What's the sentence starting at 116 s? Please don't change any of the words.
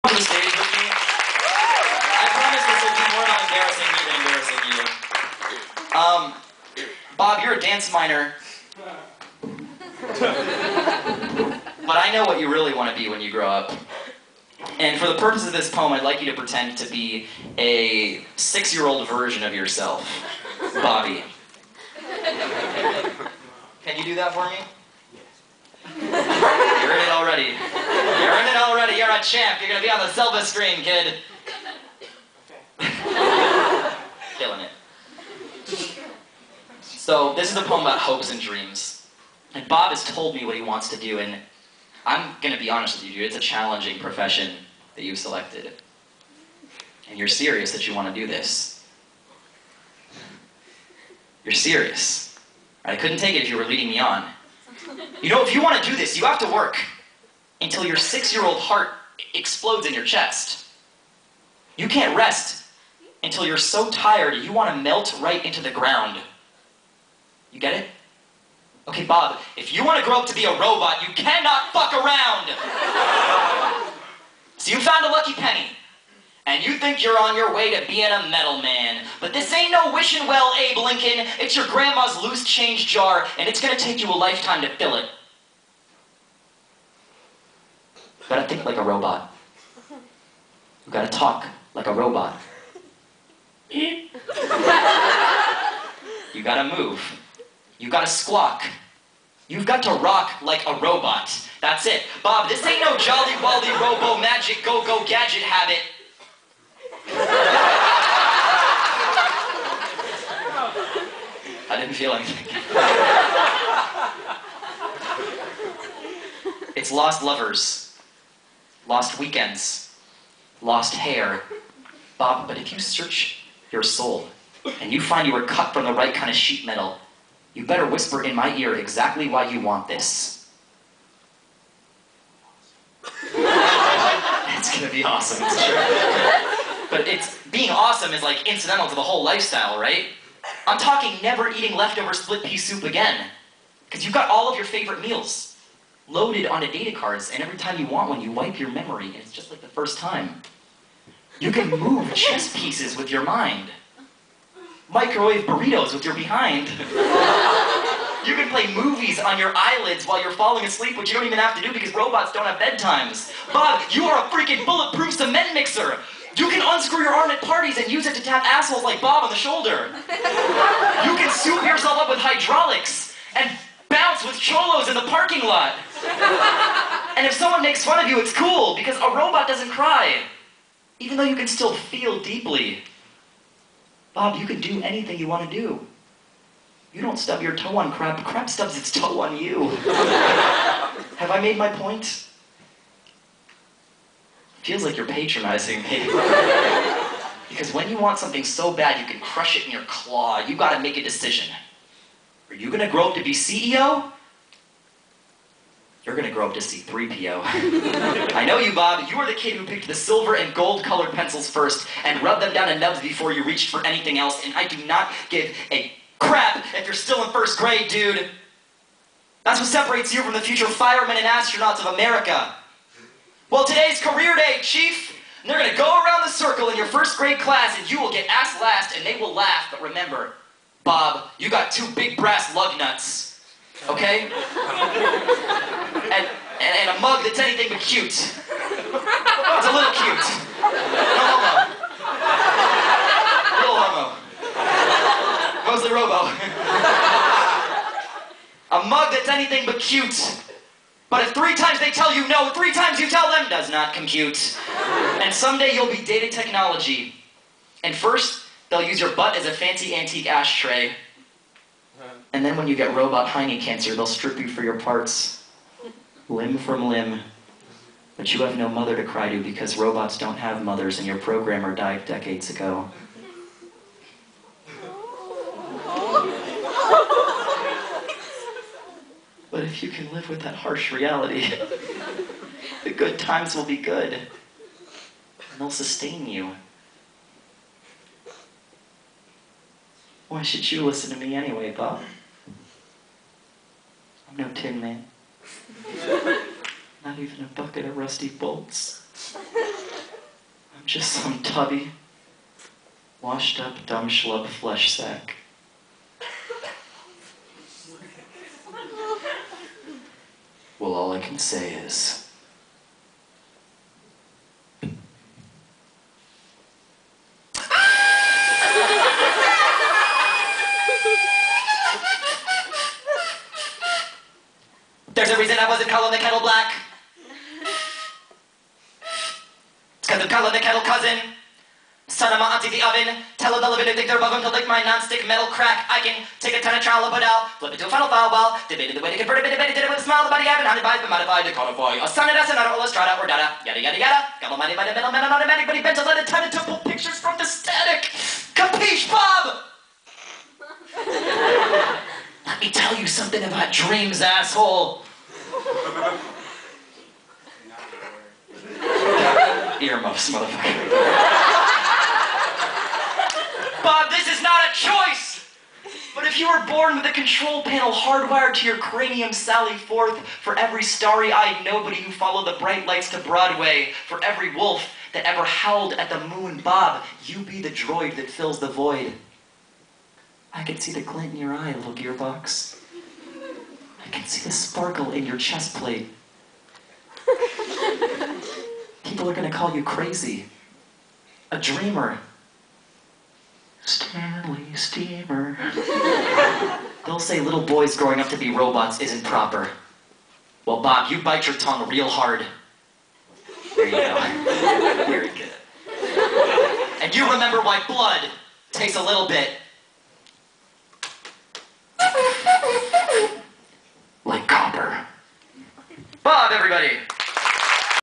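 it's lost lovers, lost weekends, lost hair.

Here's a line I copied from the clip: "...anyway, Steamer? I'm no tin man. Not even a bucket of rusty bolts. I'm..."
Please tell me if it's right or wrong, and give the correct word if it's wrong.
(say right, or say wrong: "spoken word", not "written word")
wrong: "Bob", not "Steamer".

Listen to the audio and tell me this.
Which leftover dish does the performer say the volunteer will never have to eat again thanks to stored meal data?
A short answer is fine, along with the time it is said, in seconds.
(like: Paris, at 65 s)
Split pea soup, at 142 s.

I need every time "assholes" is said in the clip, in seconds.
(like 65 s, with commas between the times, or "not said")
168 s, 354 s.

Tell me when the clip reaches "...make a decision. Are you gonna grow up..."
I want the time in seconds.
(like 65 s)
200 s.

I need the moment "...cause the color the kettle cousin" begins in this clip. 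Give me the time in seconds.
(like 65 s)
330 s.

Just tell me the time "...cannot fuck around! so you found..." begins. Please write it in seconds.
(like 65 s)
71 s.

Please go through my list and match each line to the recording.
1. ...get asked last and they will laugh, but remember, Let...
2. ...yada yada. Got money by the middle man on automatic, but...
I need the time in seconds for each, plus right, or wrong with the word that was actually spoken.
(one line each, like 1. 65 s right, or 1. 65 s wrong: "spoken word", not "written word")
1. 228 s wrong: "Bob", not "Let"
2. 343 s right.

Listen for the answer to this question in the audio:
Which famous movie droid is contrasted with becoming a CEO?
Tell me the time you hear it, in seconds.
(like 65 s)
206 s.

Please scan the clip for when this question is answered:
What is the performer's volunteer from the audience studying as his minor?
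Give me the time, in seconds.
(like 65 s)
7 s.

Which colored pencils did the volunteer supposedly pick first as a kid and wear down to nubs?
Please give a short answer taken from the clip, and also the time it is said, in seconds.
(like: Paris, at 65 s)
Silver and gold, at 209 s.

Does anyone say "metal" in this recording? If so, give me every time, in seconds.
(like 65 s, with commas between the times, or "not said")
78 s, 126 s, 335 s.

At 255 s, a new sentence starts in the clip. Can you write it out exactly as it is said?
And someday you'll be data technology.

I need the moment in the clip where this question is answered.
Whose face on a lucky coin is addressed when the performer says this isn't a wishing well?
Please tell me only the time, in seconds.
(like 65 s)
80 s.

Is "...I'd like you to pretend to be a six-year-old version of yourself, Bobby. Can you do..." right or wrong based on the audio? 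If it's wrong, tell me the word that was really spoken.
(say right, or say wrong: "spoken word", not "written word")
right.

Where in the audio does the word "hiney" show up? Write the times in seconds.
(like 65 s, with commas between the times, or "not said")
263 s.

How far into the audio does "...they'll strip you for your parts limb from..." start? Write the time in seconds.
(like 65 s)
263 s.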